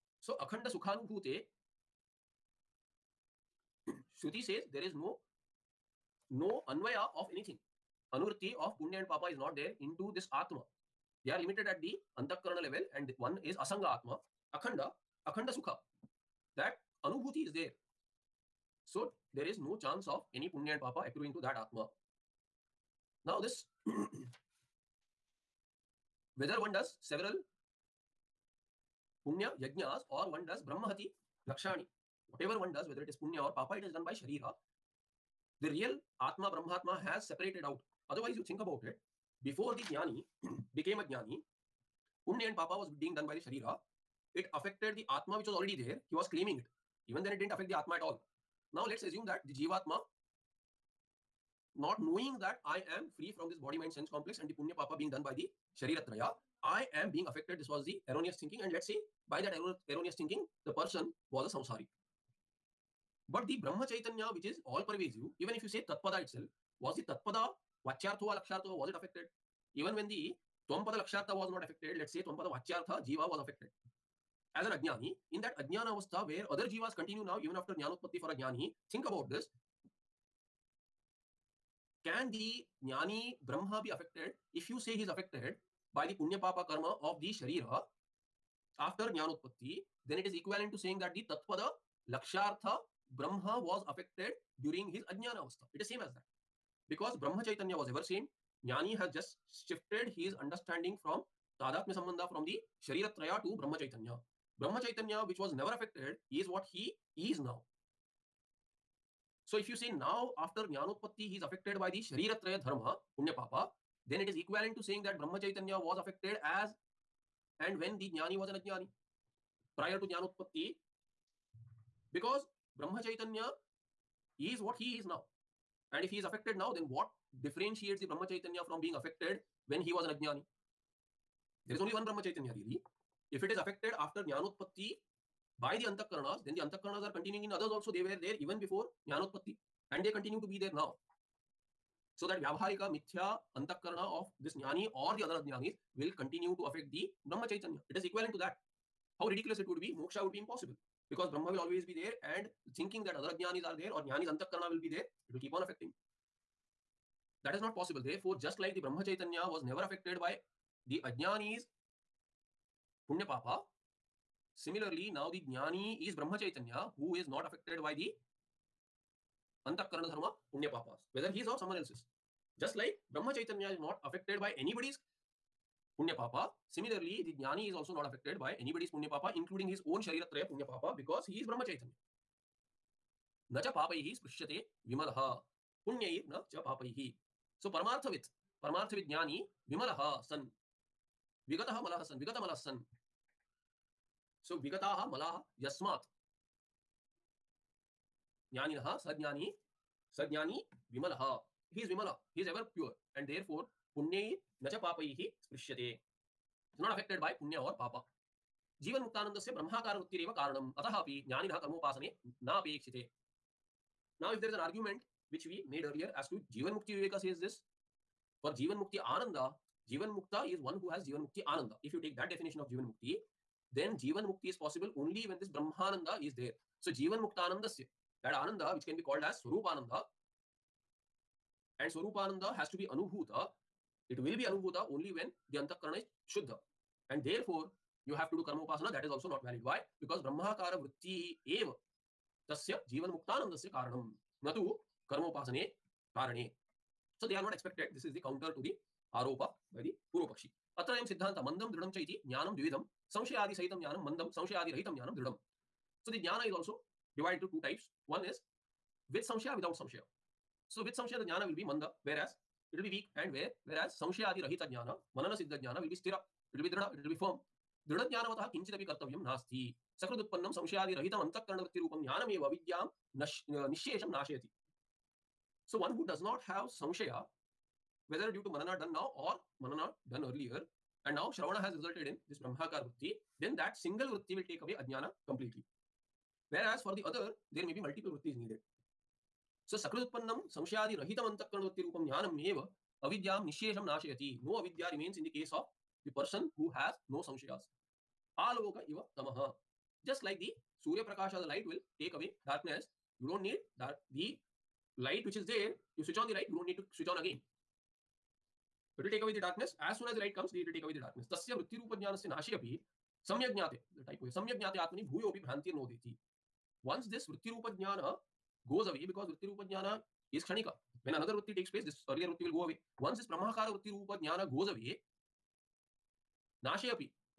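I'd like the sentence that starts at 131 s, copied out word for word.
There is only one Brahma Chaitanya really.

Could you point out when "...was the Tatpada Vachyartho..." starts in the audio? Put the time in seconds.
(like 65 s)
66 s.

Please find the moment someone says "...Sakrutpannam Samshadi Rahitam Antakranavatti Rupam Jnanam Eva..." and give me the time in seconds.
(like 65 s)
289 s.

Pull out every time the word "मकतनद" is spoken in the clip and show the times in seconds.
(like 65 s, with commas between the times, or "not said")
209 s, 243 s.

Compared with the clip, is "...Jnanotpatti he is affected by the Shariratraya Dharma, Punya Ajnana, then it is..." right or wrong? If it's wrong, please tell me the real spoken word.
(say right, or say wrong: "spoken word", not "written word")
wrong: "Papa", not "Ajnana".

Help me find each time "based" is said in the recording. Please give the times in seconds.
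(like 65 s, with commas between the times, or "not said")
not said.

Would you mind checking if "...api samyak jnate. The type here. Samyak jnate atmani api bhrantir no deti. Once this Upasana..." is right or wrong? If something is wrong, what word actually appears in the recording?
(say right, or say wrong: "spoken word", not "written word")
wrong: "Vrittirupa", not "Upasana".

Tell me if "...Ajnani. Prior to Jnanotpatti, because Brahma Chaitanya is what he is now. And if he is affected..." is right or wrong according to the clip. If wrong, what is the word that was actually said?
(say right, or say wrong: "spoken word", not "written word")
right.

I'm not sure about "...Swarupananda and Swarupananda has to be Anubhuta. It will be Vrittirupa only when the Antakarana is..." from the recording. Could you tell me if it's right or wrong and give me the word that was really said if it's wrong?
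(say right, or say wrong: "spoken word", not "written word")
wrong: "Anubhuta", not "Vrittirupa".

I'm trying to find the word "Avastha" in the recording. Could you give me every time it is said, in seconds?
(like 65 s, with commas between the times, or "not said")
75 s, 95 s.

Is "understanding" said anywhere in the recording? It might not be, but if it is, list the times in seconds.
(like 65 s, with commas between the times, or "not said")
100 s.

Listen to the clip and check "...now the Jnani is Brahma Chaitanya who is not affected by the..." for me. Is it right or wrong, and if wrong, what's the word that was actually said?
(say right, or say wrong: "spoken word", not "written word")
right.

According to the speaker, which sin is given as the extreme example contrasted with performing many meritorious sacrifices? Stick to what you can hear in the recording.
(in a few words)
brahmahati.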